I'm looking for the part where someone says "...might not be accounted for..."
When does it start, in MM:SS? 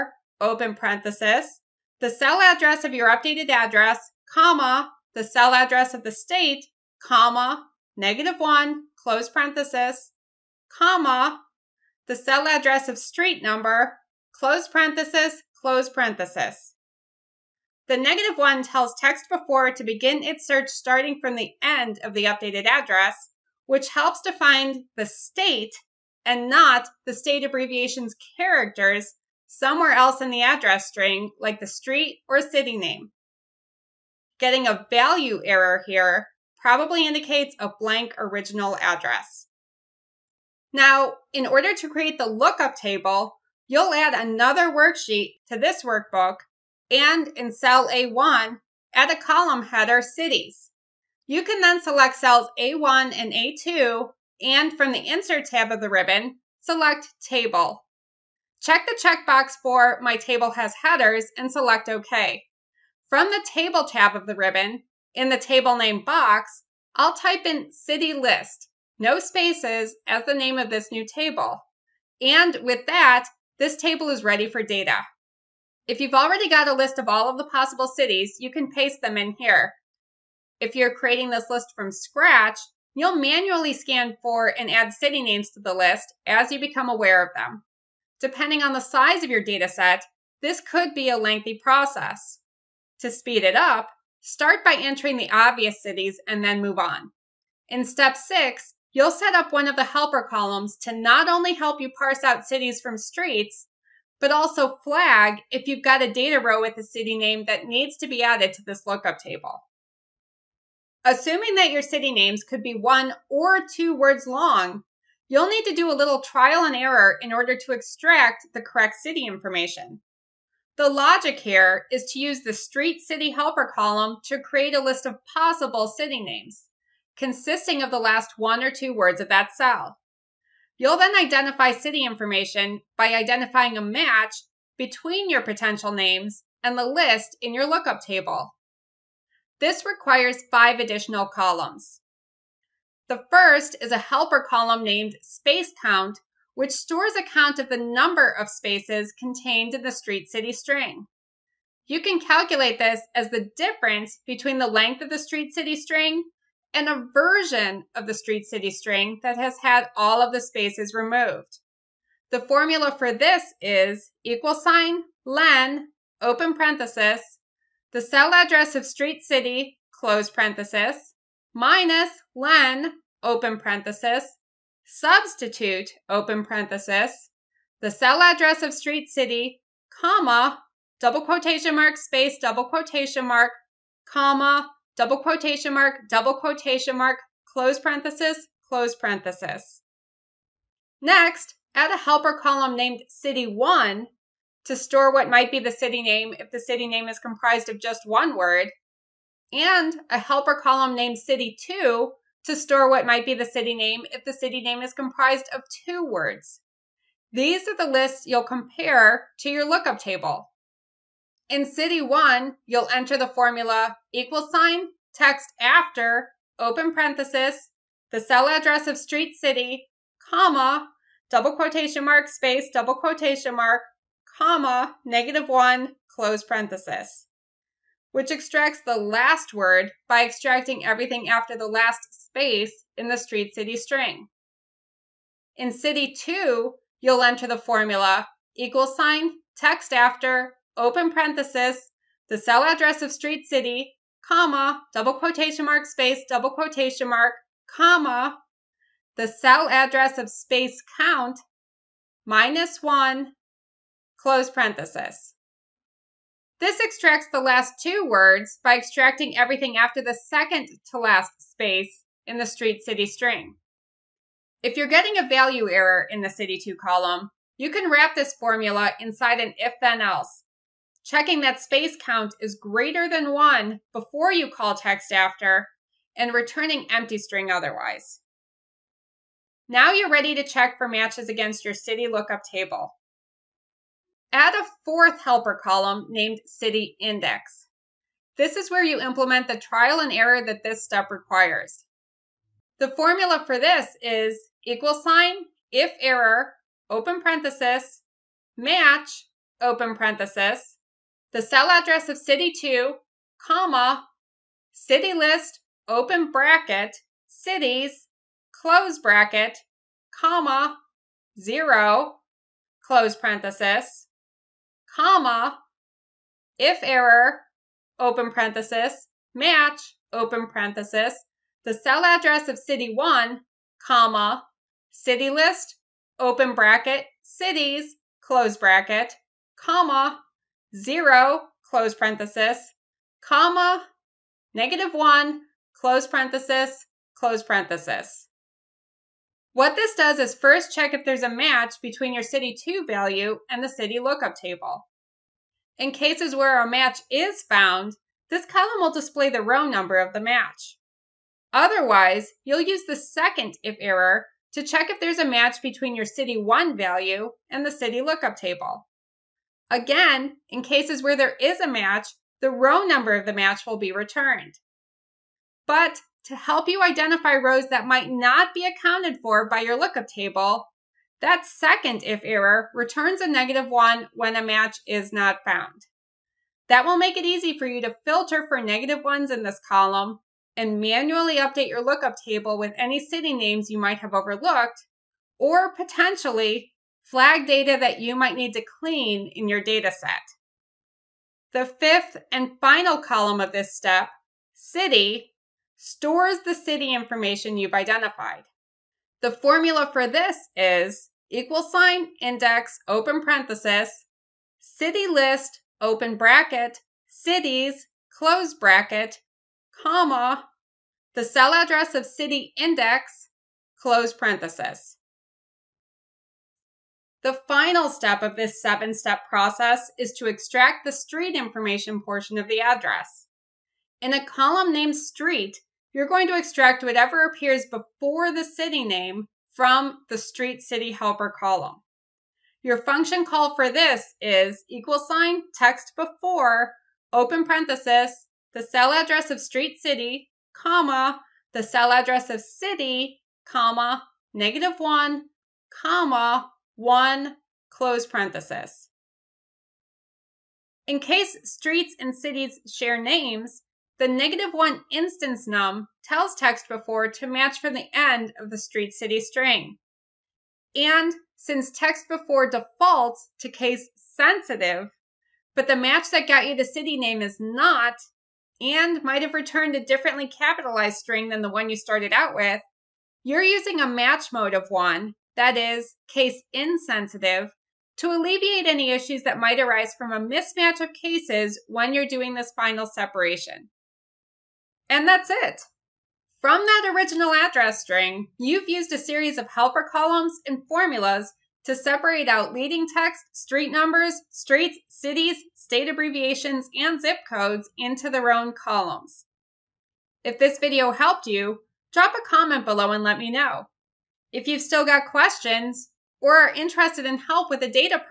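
06:07.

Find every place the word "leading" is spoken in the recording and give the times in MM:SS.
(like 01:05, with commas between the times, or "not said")
08:12.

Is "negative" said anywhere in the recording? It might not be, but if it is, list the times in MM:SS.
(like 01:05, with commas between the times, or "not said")
00:07, 00:17, 03:45, 05:34, 06:13, 06:18, 07:24, 07:34.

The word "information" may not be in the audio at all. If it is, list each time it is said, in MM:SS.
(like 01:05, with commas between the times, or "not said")
01:59, 02:12, 06:36, 07:01.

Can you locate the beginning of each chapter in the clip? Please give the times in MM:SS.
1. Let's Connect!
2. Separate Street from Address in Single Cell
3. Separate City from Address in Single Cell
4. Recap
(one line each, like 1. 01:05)
1. 08:19
2. 06:56
3. 01:50
4. 08:04.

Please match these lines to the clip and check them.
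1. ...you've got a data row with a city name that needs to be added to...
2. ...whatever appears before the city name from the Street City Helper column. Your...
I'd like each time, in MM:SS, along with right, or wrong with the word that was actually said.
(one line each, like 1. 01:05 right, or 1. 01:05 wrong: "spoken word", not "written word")
1. 01:45 right
2. 07:06 right.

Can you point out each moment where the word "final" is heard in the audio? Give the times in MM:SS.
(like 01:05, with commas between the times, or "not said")
06:32, 06:57, 08:02.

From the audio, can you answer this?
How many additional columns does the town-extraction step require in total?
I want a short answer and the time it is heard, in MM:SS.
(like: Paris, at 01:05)
5, at 02:20.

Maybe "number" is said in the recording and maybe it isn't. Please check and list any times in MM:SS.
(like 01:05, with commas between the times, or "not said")
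00:13, 02:27, 05:49, 06:02, 08:13.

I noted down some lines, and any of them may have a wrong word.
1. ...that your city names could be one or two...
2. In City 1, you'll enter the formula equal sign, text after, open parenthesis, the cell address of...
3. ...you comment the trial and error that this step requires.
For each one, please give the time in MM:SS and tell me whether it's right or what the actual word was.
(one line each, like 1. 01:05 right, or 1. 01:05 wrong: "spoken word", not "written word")
1. 01:51 right
2. 03:31 right
3. 04:48 wrong: "implement", not "comment".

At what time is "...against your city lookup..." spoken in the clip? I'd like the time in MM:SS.
04:41.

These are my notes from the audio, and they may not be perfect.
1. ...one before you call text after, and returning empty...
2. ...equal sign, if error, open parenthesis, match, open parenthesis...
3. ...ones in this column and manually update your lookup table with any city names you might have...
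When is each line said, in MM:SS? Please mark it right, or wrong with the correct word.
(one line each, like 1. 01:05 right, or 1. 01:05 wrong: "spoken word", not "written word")
1. 04:33 right
2. 04:54 right
3. 06:19 right.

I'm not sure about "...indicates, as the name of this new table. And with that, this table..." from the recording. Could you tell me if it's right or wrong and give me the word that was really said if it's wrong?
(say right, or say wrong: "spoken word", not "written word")
wrong: "spaces", not "indicates".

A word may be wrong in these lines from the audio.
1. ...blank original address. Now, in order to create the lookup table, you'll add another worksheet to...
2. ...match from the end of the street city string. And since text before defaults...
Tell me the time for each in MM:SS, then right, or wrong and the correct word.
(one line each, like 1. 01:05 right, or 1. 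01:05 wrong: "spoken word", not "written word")
1. 00:37 right
2. 07:37 right.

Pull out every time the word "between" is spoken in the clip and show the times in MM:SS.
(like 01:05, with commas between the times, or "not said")
02:14, 02:34, 05:41, 05:55.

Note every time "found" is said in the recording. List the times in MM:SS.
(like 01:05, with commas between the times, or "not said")
05:47, 06:15.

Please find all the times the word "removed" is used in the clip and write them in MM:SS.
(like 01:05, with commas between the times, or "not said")
02:40.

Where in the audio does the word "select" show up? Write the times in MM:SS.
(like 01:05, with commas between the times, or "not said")
00:51, 00:56, 01:01.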